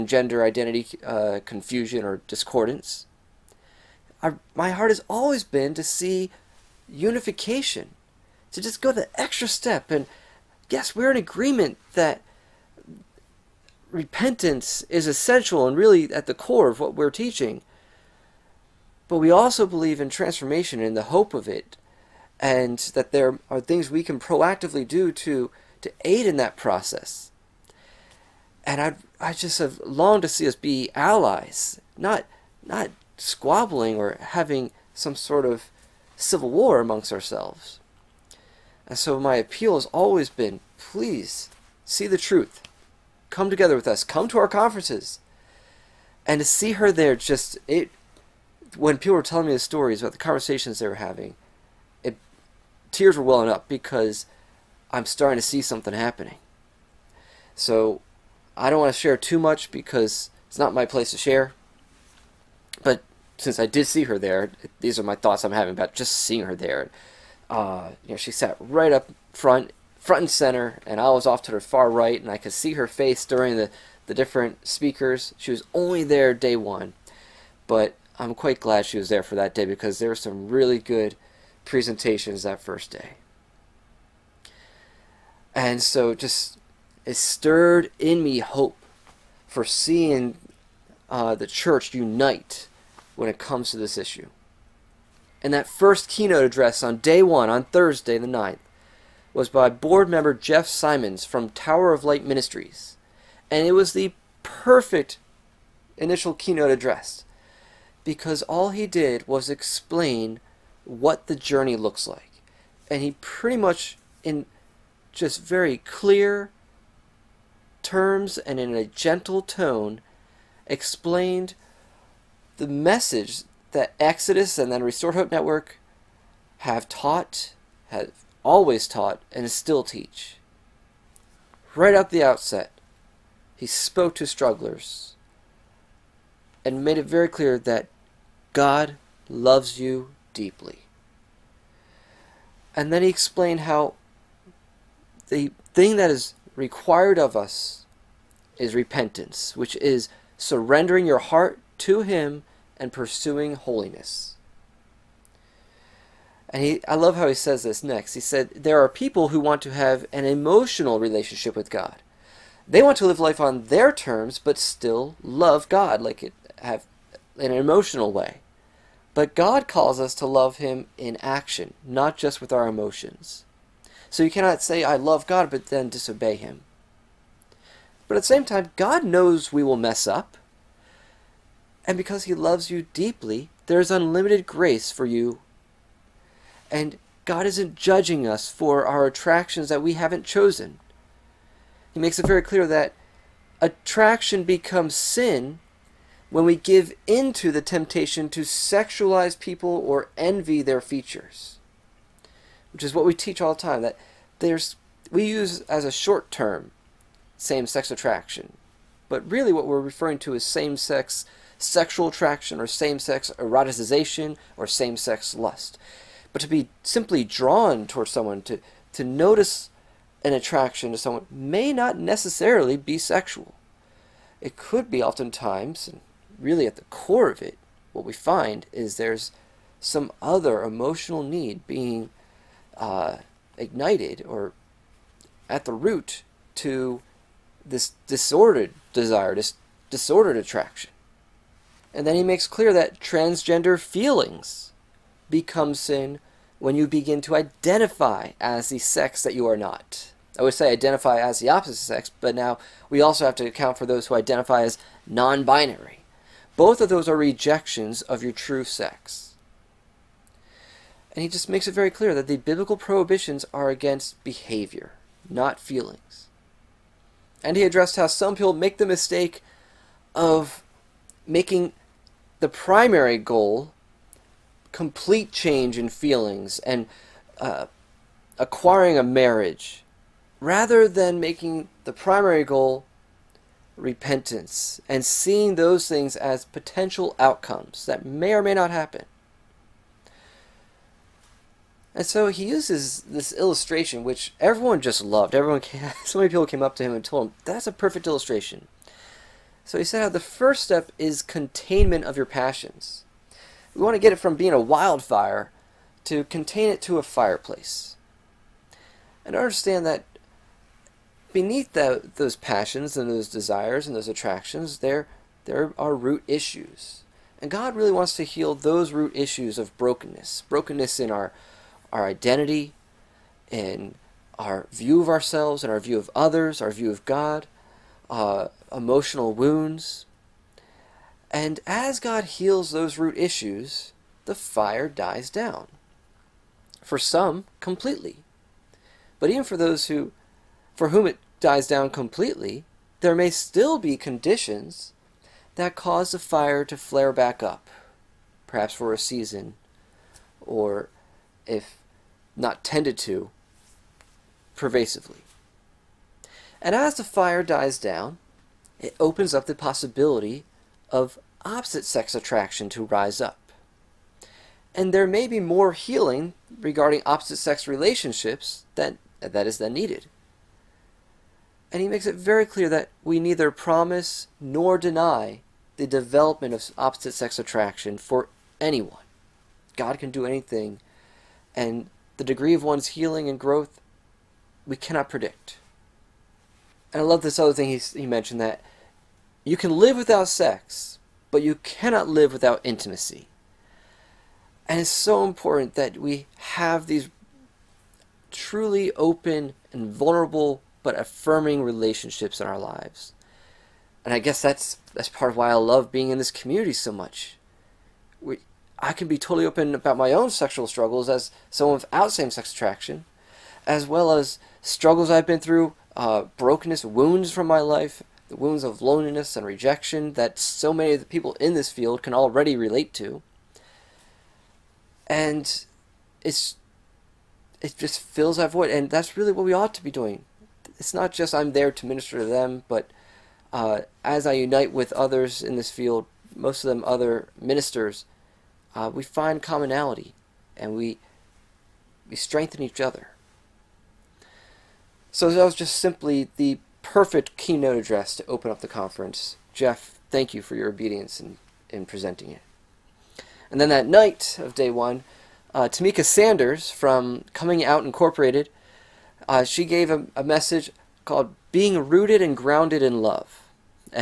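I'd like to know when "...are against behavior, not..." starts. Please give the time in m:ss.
4:23.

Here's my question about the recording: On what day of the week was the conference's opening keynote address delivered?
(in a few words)
Thursday.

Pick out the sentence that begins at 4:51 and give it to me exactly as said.
And so he uses this illustration, which everyone just loved.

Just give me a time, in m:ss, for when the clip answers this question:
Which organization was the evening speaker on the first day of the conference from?
7:37.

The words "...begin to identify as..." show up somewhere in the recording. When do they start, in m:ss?
4:06.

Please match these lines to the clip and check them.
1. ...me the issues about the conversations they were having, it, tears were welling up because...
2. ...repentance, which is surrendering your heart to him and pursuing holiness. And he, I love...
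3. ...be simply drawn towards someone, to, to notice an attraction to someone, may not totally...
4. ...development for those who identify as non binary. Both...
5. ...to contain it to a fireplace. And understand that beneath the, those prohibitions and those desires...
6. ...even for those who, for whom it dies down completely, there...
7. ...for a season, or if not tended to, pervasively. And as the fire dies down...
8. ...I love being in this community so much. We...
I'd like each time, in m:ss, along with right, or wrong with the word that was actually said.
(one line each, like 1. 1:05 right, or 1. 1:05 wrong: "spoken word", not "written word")
1. 0:49 wrong: "stories", not "issues"
2. 2:28 right
3. 3:36 wrong: "necessarily", not "totally"
4. 4:13 wrong: "account", not "development"
5. 5:06 wrong: "passions", not "prohibitions"
6. 5:39 right
7. 5:48 right
8. 6:45 right.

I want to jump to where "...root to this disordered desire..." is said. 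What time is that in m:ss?
3:55.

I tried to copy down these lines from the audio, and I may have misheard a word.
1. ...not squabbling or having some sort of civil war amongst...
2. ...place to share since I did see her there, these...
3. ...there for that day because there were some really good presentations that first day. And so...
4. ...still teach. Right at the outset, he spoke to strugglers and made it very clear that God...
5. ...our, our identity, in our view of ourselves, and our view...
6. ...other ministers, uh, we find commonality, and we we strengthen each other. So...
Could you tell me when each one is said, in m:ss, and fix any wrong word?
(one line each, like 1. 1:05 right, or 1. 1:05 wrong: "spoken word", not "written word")
1. 0:32 right
2. 1:00 right
3. 1:19 right
4. 2:09 right
5. 5:21 right
6. 7:16 right.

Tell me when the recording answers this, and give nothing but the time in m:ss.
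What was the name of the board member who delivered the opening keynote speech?
1:40.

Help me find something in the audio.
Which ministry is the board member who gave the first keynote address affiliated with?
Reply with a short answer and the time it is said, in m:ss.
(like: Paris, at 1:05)
Tower of Light Ministries, at 1:41.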